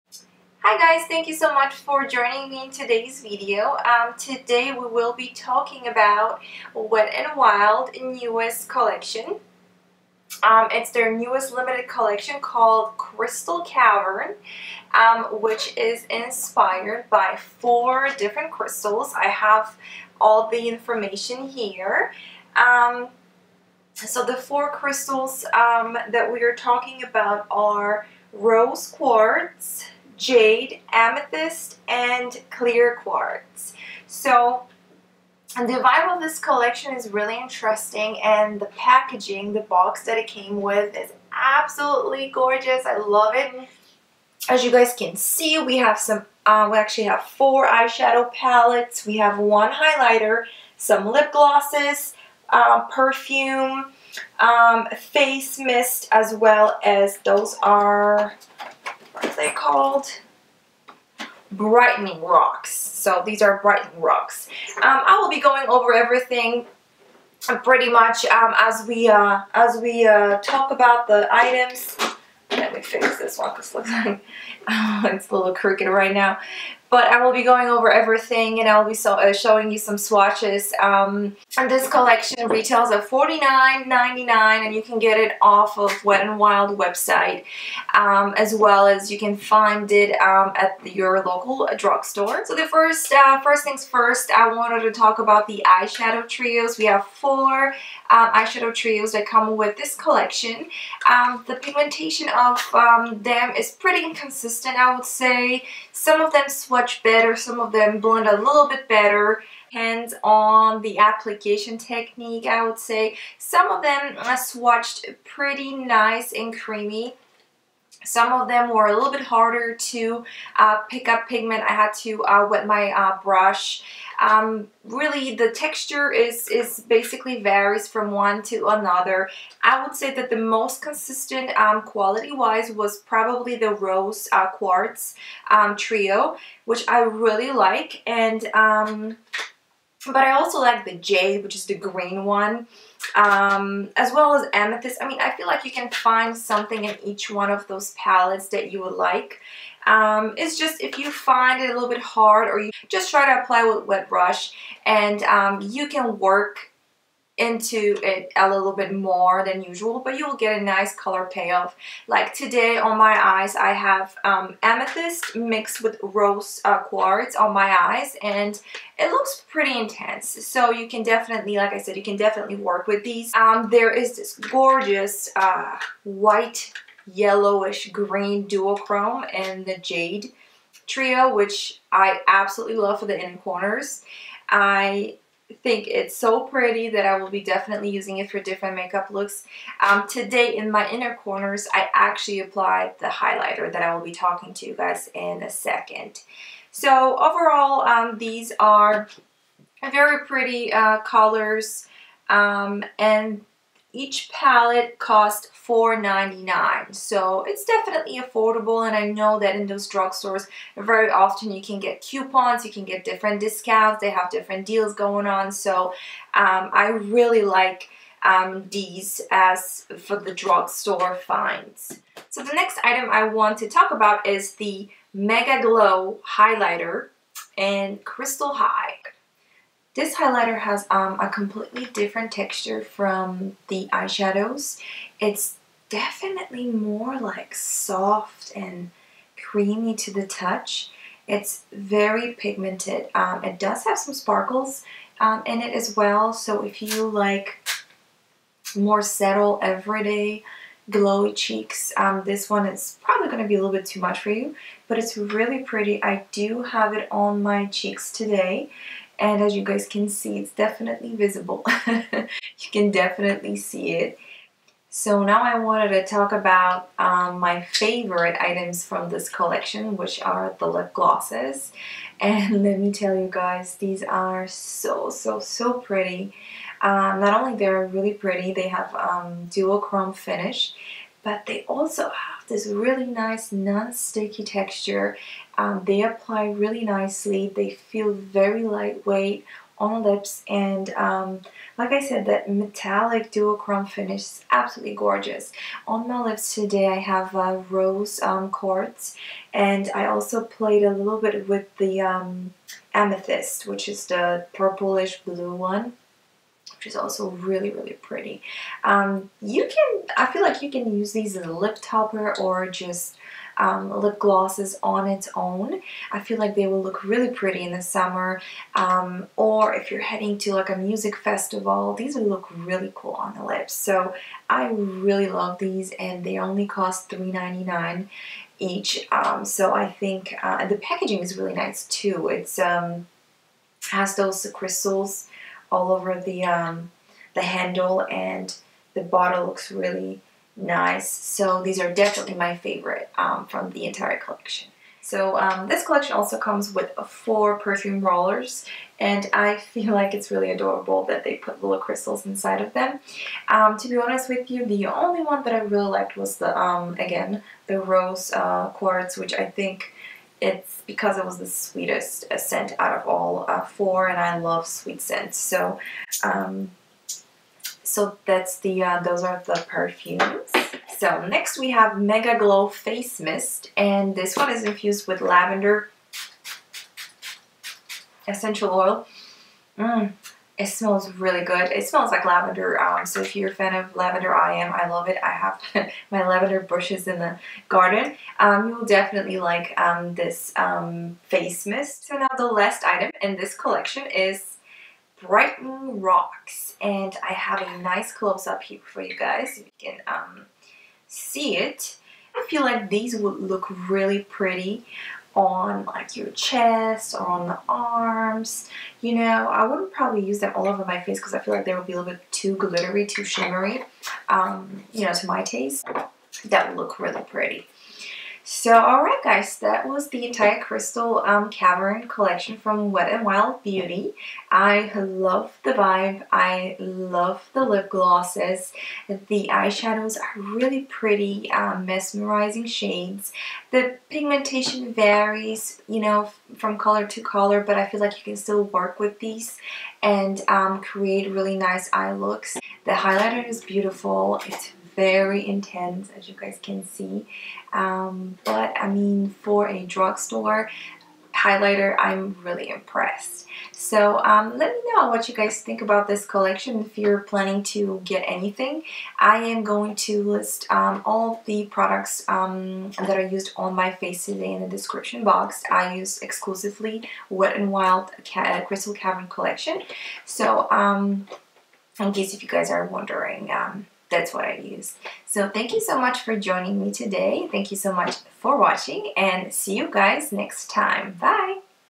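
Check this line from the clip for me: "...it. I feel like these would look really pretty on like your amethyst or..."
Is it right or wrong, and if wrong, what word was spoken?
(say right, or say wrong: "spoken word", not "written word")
wrong: "chest", not "amethyst".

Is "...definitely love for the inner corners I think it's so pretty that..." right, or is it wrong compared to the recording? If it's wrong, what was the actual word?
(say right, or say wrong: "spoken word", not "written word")
wrong: "absolutely", not "definitely".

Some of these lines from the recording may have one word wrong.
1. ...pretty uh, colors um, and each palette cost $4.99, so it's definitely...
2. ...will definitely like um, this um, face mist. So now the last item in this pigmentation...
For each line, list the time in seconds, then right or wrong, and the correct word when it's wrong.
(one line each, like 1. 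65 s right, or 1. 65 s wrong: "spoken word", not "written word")
1. 200 s right
2. 388 s wrong: "collection", not "pigmentation".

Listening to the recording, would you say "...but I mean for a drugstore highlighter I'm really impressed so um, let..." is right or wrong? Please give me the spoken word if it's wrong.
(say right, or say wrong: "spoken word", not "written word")
right.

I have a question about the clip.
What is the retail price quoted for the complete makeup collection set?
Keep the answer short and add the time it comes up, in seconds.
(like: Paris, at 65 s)
$49.99, at 83 s.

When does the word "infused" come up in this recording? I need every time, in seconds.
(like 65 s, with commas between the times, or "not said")
374 s.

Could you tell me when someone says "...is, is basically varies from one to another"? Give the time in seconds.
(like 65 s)
126 s.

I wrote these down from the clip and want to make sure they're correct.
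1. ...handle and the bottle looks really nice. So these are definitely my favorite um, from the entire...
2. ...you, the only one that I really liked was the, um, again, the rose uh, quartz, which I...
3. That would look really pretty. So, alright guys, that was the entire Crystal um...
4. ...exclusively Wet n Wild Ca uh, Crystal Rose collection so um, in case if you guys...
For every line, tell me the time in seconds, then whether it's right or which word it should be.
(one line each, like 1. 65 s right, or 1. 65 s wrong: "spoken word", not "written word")
1. 337 s right
2. 354 s right
3. 416 s right
4. 466 s wrong: "Cavern", not "Rose".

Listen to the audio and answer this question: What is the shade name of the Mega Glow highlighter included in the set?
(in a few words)
Crystal High.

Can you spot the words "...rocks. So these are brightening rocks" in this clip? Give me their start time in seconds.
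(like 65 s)
62 s.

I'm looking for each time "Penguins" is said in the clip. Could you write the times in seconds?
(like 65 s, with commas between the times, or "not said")
not said.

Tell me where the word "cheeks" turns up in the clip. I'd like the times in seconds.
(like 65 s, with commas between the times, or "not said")
251 s, 257 s.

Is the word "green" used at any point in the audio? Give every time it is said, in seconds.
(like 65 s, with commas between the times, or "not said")
141 s, 177 s.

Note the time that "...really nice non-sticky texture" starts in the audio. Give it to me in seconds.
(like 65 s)
282 s.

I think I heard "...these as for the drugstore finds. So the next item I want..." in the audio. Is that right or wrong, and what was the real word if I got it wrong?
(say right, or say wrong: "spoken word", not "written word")
right.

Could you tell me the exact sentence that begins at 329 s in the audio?
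Um, so I think uh, the packaging is really nice too.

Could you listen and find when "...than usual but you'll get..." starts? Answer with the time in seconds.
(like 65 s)
159 s.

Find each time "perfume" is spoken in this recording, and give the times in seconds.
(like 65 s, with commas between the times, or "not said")
52 s, 347 s, 369 s.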